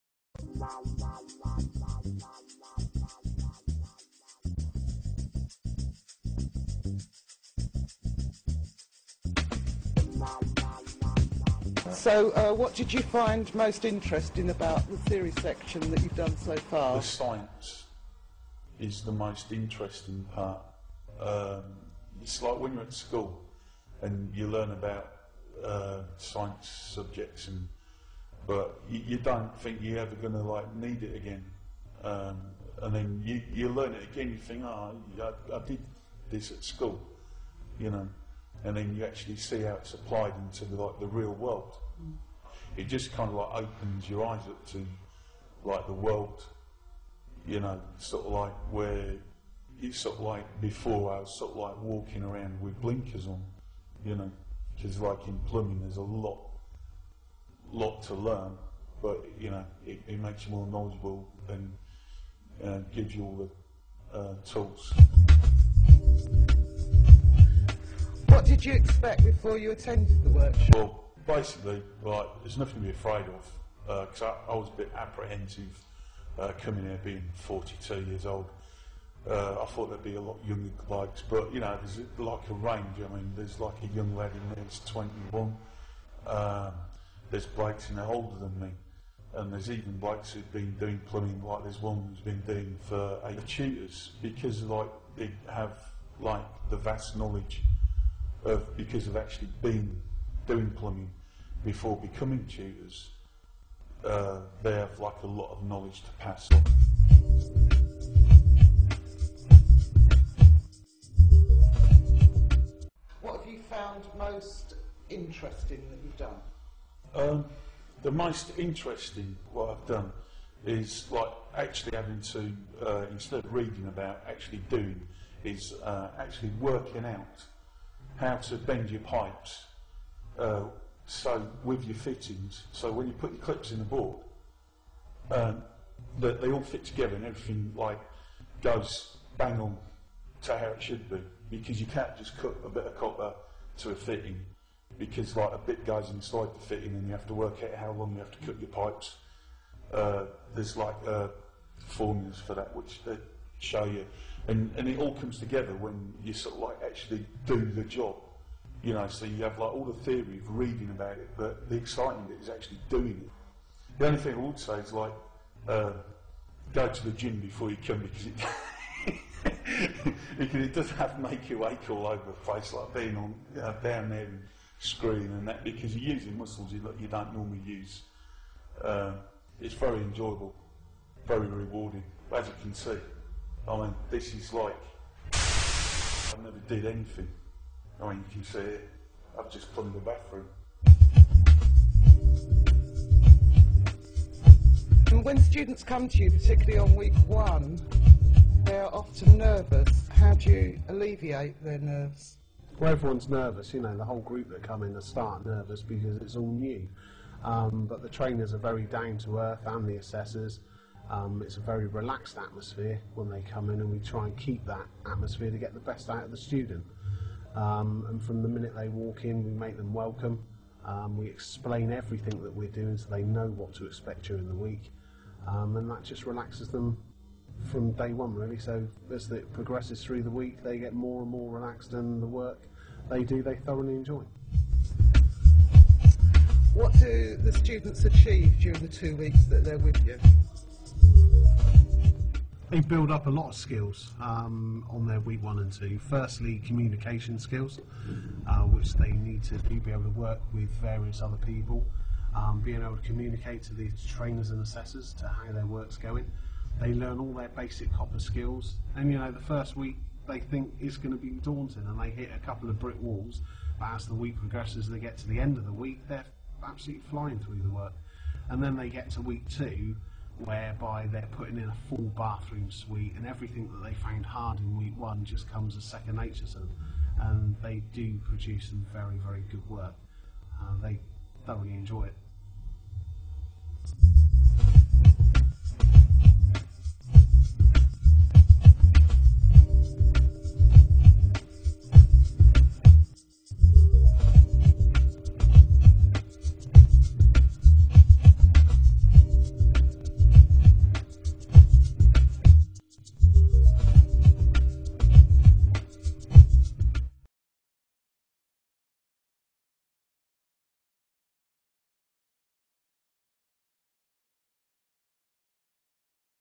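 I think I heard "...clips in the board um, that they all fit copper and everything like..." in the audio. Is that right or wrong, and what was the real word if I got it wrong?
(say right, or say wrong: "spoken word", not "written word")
wrong: "together", not "copper".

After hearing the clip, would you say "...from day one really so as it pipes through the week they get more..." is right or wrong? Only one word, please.
wrong.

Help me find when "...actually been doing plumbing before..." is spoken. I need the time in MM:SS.
01:39.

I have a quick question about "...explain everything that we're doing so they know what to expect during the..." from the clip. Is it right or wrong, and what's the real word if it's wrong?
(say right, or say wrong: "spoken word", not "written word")
right.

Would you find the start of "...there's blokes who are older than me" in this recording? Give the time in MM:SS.
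01:27.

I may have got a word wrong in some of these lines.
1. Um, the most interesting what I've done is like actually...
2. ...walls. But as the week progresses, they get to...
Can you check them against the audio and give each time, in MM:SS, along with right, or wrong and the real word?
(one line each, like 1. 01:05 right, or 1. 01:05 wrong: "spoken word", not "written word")
1. 01:57 right
2. 04:22 right.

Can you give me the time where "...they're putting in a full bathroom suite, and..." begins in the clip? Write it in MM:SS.
04:31.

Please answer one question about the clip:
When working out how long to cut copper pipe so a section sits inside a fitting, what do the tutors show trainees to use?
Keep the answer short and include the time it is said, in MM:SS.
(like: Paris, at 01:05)
formulas, at 02:31.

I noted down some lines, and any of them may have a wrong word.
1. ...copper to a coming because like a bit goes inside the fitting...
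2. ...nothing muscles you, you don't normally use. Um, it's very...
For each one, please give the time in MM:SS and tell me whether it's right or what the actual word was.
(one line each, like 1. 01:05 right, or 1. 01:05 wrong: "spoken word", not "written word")
1. 02:22 wrong: "fitting", not "coming"
2. 02:56 wrong: "using", not "nothing".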